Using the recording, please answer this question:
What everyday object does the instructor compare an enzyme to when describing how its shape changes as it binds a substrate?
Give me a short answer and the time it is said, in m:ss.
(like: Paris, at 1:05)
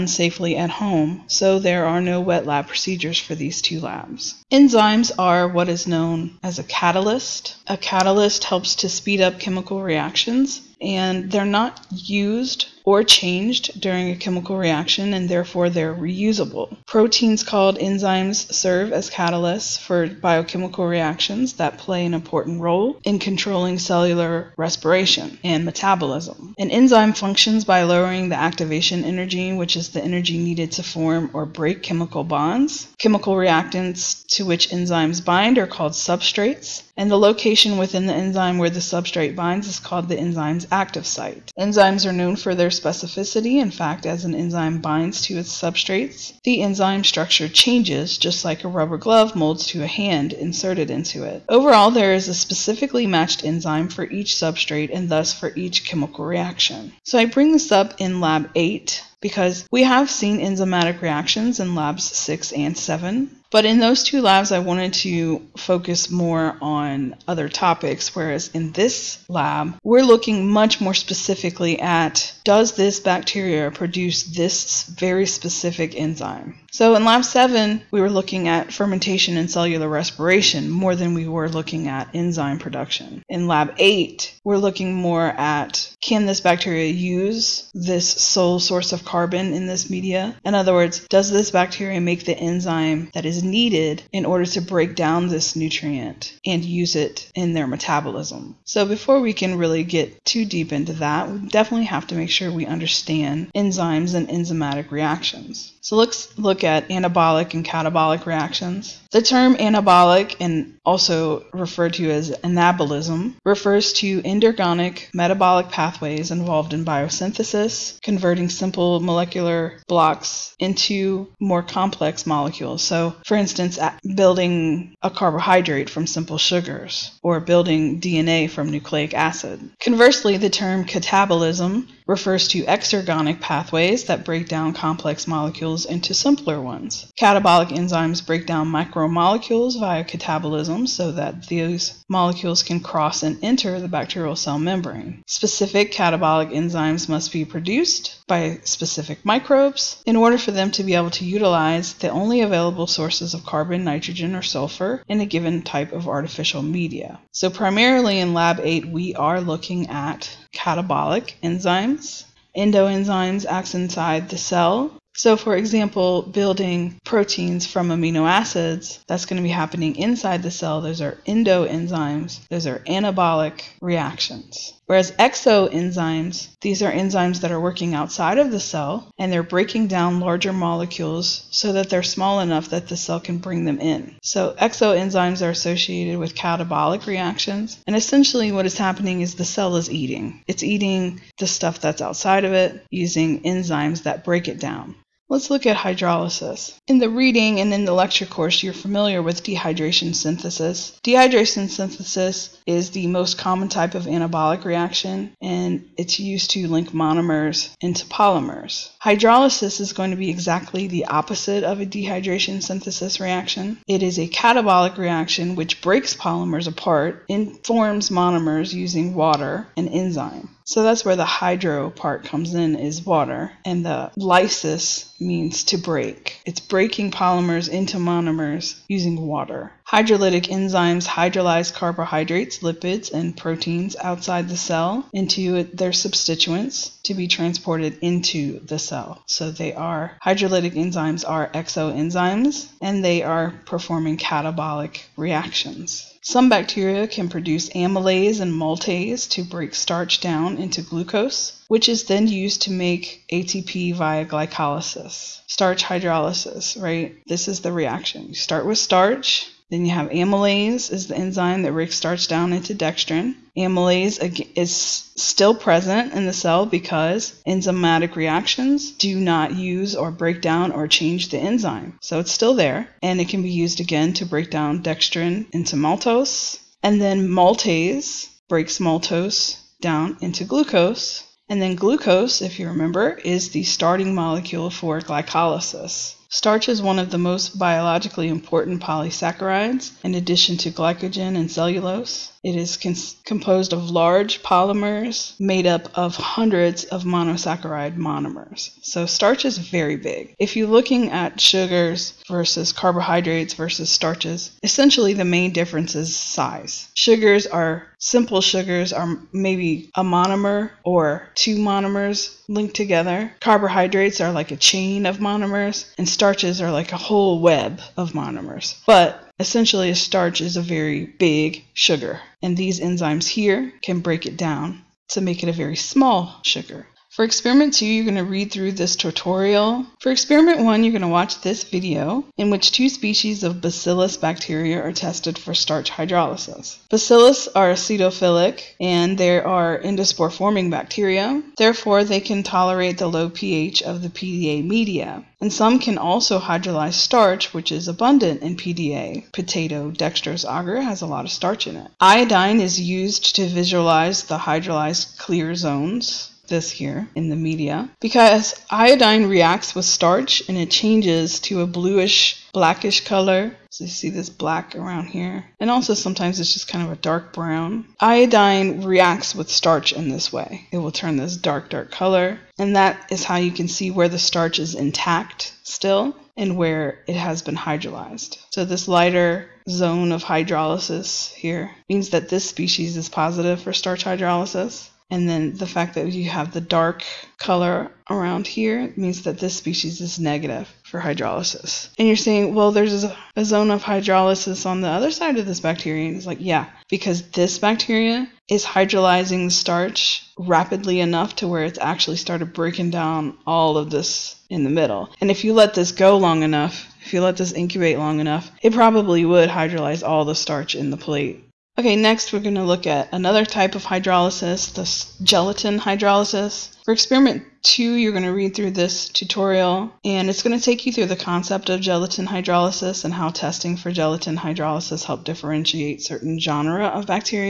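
Rubber glove, at 0:48.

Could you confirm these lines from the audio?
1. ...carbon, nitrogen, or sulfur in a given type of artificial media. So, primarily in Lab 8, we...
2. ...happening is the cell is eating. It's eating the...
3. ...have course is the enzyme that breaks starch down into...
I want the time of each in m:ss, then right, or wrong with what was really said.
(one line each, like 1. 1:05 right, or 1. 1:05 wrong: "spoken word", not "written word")
1. 2:33 right
2. 3:08 right
3. 4:19 wrong: "amylase", not "course".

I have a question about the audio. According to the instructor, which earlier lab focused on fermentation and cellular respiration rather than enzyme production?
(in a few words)
Lab 7.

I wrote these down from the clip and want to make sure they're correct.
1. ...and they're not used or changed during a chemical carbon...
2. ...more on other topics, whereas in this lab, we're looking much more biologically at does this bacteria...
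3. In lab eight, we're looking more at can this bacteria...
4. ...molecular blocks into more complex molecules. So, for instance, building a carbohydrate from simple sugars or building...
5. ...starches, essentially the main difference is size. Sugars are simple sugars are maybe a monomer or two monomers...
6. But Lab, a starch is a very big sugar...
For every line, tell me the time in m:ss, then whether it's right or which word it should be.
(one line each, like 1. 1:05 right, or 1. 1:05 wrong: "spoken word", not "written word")
1. 0:10 wrong: "reaction", not "carbon"
2. 1:06 wrong: "specifically", not "biologically"
3. 1:23 right
4. 1:59 right
5. 5:03 right
6. 5:18 wrong: "Essentially", not "Lab".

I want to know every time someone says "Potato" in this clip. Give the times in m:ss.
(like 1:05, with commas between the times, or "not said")
5:49.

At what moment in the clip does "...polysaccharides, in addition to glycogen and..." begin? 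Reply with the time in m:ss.
4:48.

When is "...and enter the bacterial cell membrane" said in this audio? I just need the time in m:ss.
2:23.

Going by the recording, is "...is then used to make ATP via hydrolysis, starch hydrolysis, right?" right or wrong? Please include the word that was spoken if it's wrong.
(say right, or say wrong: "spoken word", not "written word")
wrong: "glycolysis", not "hydrolysis".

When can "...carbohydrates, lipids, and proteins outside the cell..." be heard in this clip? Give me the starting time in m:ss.
3:51.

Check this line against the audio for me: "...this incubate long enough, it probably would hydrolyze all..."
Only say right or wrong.
right.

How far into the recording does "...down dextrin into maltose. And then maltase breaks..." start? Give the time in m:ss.
4:34.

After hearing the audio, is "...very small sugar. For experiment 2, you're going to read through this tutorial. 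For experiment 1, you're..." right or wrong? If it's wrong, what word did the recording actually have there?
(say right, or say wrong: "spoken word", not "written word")
right.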